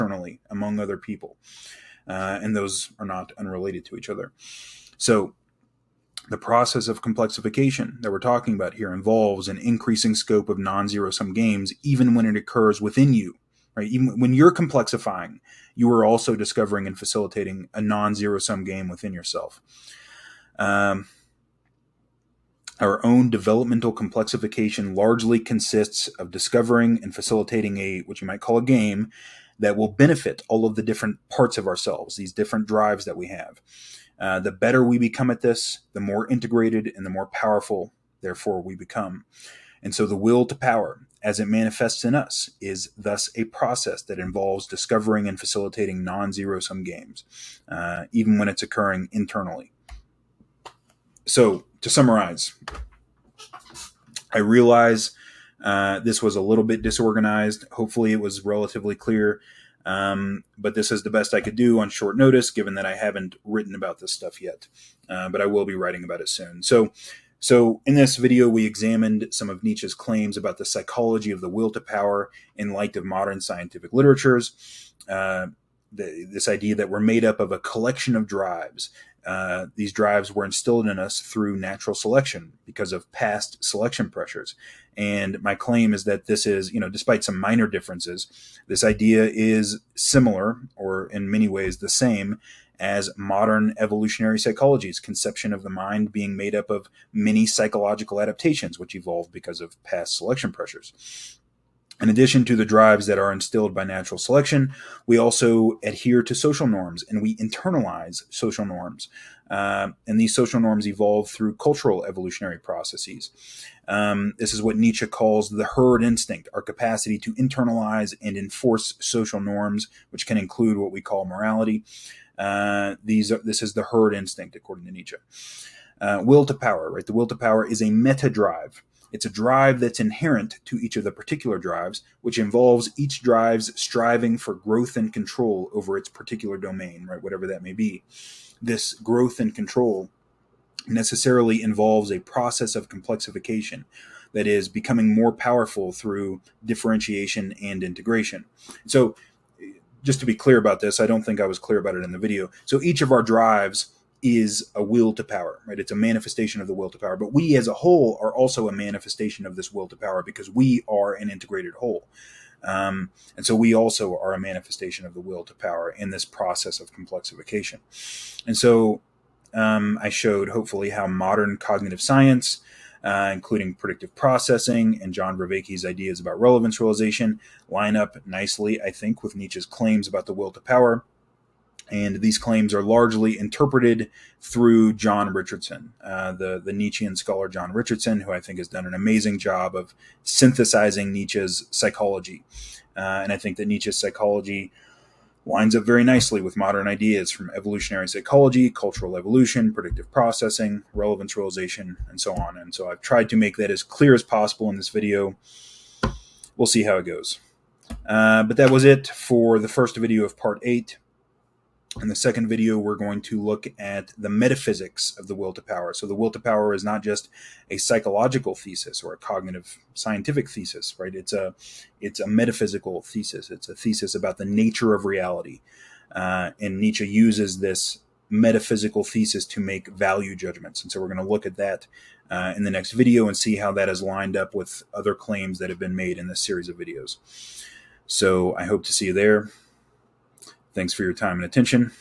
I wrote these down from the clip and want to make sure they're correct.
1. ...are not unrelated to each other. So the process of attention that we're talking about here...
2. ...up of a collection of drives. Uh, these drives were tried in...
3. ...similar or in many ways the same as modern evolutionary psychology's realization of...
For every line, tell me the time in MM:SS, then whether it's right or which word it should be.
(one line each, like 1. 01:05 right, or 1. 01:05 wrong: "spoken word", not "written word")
1. 00:02 wrong: "complexification", not "attention"
2. 01:17 wrong: "instilled", not "tried"
3. 01:29 wrong: "conception", not "realization".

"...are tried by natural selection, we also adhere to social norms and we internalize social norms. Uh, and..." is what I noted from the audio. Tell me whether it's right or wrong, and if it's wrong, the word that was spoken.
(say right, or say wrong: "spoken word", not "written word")
wrong: "instilled", not "tried".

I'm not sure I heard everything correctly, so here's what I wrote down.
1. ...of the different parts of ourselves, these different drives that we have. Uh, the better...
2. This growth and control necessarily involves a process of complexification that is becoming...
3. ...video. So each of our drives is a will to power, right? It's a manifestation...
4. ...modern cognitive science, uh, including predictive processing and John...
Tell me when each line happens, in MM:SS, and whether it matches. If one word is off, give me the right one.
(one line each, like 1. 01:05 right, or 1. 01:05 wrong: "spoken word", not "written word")
1. 00:30 right
2. 02:18 right
3. 02:32 right
4. 02:51 right.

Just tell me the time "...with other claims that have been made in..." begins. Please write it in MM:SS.
03:54.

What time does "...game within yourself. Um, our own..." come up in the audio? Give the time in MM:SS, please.
00:18.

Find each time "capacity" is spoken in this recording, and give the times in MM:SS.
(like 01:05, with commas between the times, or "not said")
01:56.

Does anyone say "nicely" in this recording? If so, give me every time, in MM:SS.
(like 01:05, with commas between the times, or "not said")
02:58, 03:16.